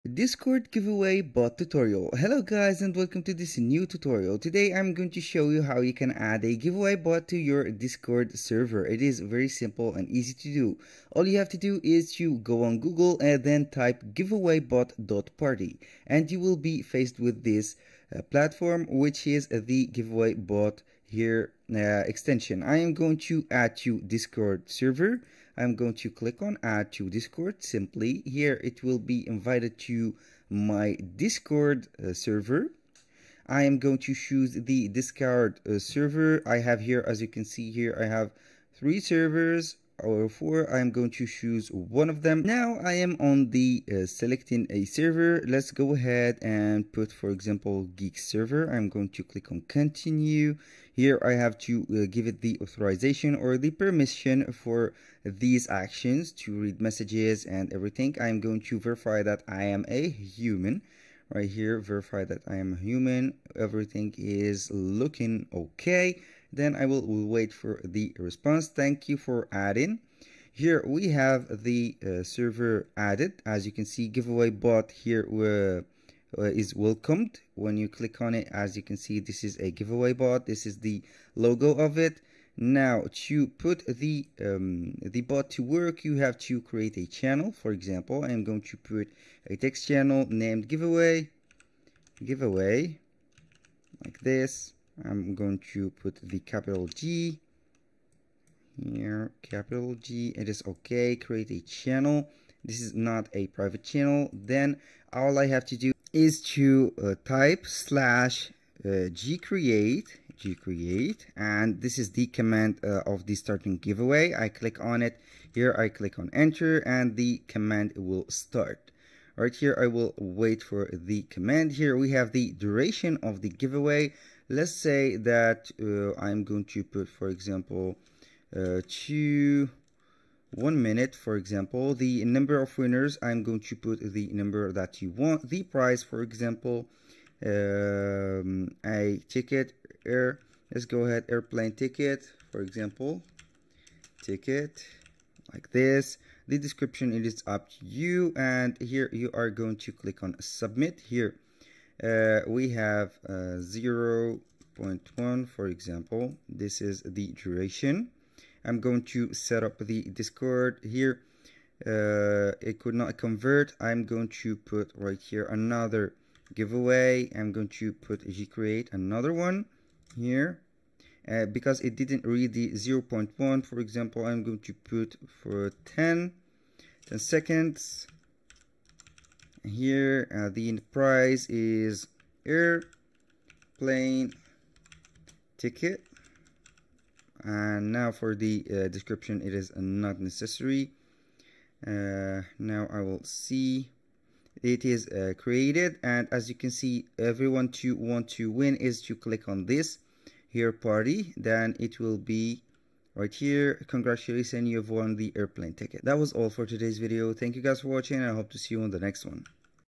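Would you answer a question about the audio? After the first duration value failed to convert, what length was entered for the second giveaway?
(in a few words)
10 seconds.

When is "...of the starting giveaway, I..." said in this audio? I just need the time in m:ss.
1:53.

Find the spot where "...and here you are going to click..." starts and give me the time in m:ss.
2:28.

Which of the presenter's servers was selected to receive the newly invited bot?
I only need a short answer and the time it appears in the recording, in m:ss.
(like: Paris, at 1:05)
geek server, at 0:47.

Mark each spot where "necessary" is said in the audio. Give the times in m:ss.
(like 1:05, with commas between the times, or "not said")
3:10.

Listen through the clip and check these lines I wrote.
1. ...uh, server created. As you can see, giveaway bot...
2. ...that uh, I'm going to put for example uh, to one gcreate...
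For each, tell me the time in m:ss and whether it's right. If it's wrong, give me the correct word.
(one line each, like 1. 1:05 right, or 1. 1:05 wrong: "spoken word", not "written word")
1. 1:12 wrong: "added", not "created"
2. 2:05 wrong: "minute", not "gcreate".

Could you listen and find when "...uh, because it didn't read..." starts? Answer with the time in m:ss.
2:51.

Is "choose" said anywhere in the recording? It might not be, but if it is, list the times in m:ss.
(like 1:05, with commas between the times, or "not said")
0:34, 0:41.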